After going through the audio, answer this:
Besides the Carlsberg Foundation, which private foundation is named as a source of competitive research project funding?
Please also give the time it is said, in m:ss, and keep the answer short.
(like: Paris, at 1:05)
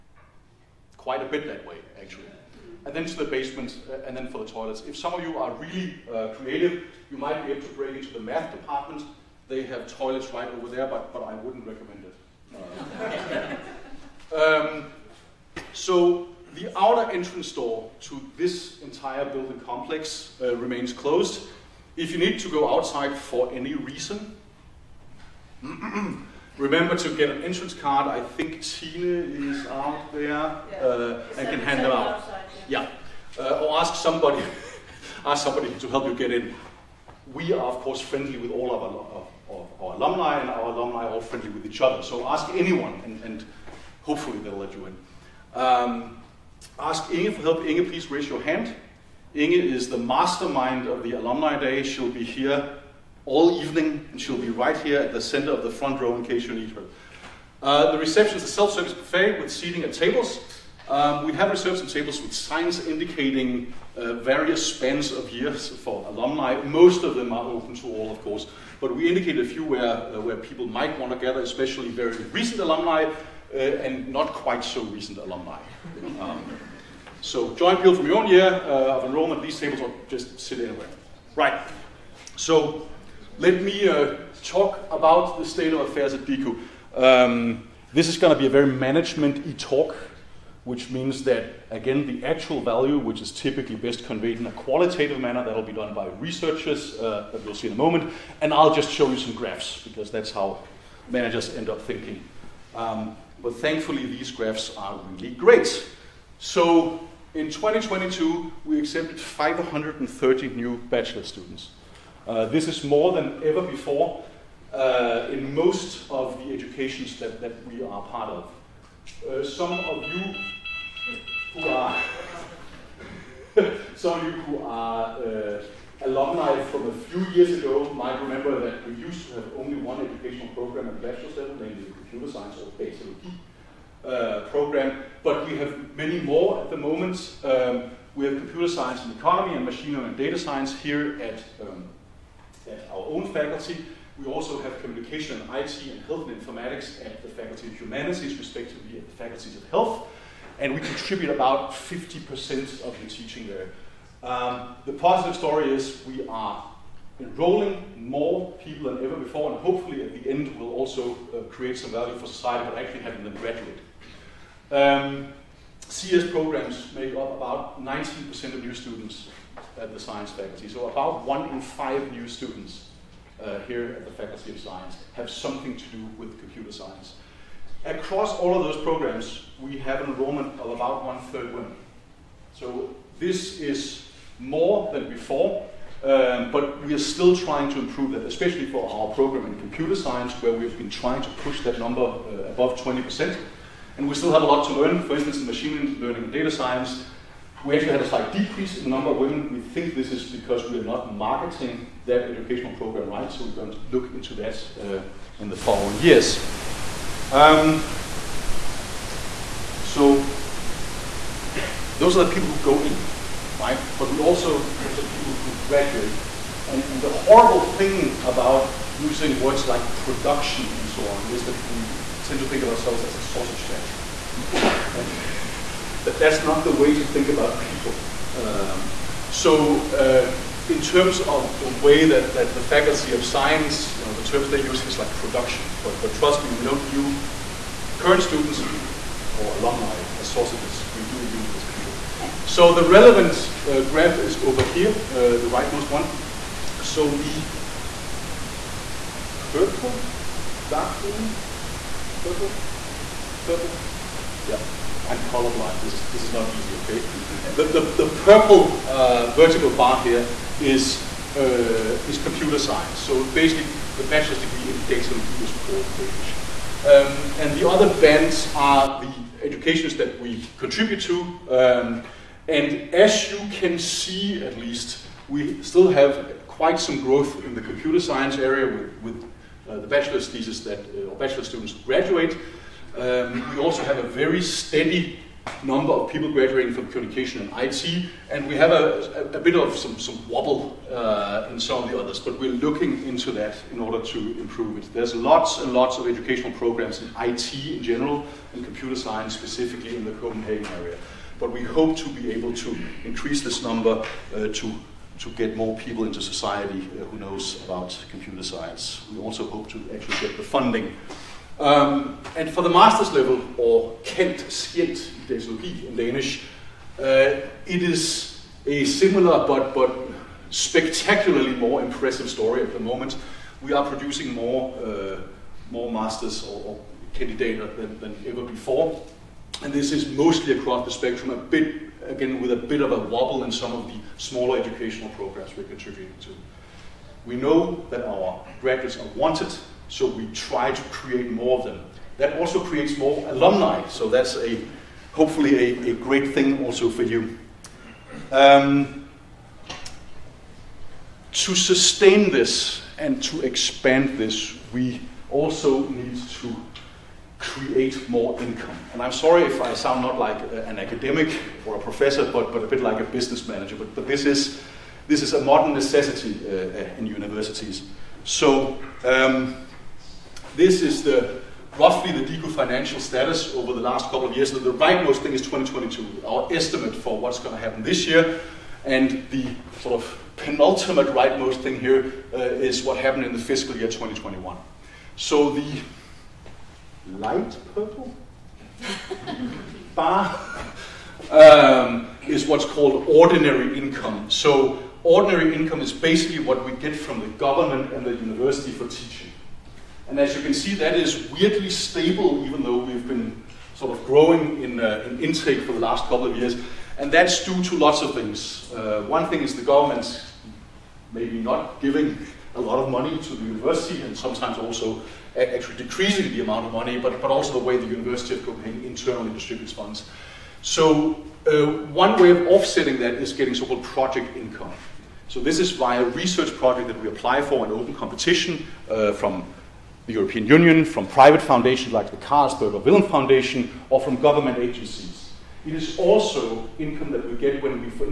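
Villum Foundation, at 7:12.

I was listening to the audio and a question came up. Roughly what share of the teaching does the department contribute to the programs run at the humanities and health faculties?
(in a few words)
50%.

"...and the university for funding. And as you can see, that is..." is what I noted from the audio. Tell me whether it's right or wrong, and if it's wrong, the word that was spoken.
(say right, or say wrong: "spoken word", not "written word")
wrong: "teaching", not "funding".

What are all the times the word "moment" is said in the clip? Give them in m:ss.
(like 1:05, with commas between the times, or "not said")
1:37, 2:16, 5:22.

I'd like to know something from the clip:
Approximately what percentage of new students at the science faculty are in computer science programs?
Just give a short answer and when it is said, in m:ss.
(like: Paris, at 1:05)
19%, at 2:47.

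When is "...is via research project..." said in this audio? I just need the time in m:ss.
7:05.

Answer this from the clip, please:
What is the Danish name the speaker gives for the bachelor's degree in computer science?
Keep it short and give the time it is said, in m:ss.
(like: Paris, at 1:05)
datalogy, at 4:24.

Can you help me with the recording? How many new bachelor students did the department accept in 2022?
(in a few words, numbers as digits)
530.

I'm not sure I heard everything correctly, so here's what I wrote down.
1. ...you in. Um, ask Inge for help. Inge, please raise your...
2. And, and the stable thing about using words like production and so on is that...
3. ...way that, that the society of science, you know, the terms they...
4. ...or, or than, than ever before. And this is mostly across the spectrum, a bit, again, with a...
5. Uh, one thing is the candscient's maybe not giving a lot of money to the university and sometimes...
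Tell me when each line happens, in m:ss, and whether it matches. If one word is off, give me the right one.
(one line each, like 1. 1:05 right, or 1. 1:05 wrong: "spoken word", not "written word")
1. 0:44 right
2. 3:36 wrong: "horrible", not "stable"
3. 3:51 wrong: "faculty", not "society"
4. 5:26 right
5. 6:48 wrong: "government", not "candscient".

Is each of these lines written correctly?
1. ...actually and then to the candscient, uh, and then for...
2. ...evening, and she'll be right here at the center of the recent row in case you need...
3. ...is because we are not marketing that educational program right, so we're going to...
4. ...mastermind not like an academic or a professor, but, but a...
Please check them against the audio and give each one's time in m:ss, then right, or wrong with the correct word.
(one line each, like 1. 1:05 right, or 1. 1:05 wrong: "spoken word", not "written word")
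1. 0:02 wrong: "basement", not "candscient"
2. 0:53 wrong: "front", not "recent"
3. 3:20 right
4. 5:59 wrong: "sound", not "mastermind".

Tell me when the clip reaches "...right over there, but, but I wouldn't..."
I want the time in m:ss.
0:10.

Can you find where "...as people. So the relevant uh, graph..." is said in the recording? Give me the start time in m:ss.
4:01.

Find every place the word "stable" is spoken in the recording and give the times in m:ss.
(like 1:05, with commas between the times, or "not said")
6:41.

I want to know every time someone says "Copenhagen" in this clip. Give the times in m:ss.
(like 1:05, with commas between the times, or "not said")
5:00, 6:58.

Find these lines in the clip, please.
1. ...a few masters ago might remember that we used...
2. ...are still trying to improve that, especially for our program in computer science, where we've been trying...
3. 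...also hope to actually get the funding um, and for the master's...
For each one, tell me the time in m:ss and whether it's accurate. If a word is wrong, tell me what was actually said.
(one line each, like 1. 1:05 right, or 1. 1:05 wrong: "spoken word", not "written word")
1. 2:06 wrong: "years", not "masters"
2. 3:06 right
3. 5:09 right.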